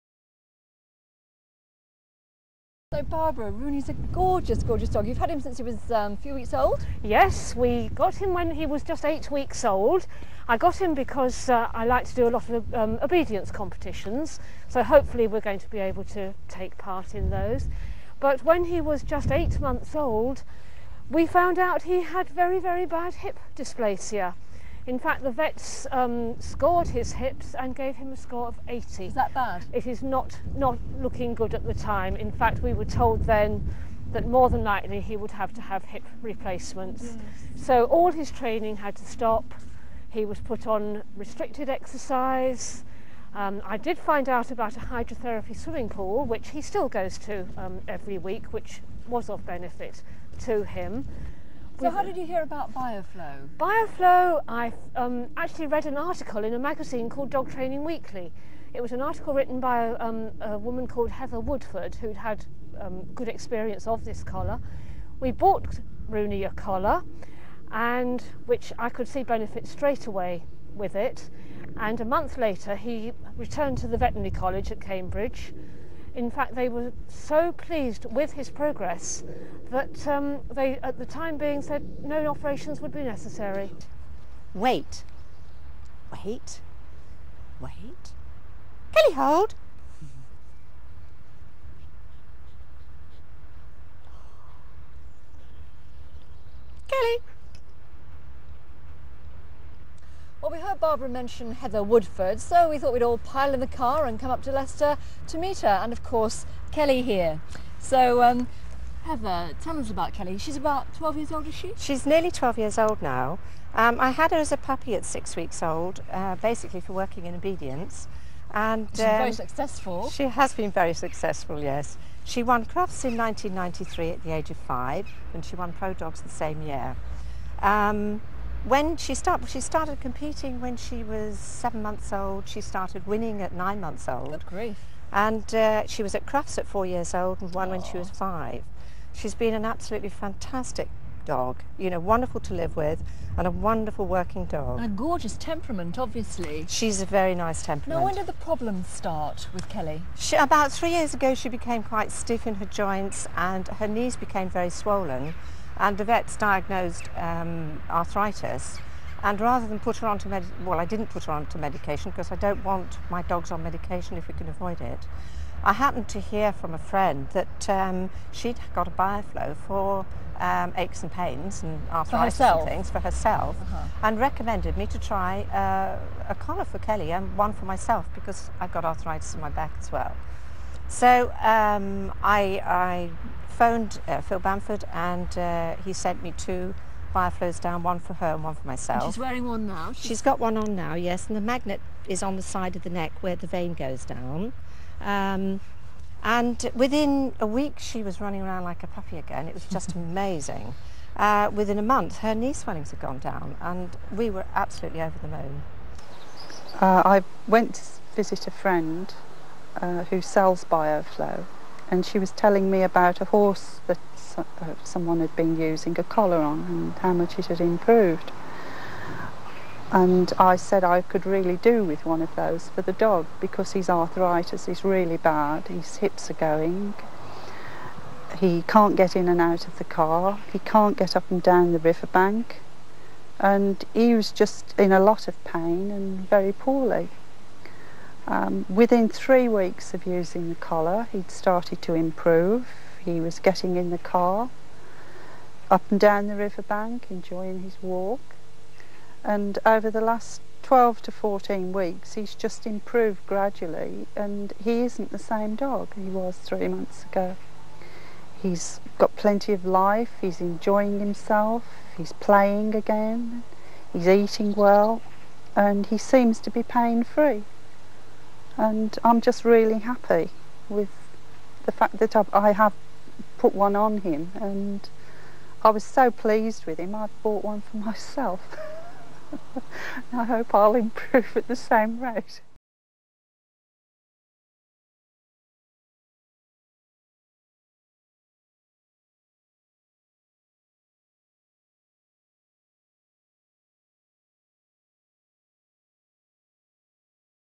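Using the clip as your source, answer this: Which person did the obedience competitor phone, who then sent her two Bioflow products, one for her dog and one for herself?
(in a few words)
Phil Bamford.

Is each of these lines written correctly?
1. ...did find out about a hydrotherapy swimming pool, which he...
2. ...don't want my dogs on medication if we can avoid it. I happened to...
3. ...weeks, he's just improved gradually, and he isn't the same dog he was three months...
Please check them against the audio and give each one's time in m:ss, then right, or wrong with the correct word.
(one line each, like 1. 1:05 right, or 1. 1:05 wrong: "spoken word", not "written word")
1. 0:43 right
2. 2:42 right
3. 4:11 right.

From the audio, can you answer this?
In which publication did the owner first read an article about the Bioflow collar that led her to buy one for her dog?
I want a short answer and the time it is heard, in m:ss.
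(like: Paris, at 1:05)
Dog Training Weekly, at 0:57.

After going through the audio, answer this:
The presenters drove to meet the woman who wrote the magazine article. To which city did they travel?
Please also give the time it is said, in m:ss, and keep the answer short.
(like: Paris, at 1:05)
Leicester, at 1:44.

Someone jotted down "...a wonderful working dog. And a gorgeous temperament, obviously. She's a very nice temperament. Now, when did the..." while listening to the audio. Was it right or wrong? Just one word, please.
right.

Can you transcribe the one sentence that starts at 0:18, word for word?
But when he was just eight months old, we found out he had very, very bad hip dysplasia.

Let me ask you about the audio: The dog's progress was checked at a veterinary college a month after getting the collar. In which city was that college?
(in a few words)
Cambridge.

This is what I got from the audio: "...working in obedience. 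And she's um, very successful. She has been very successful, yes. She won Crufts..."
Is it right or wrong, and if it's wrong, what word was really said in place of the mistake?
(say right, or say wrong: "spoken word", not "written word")
right.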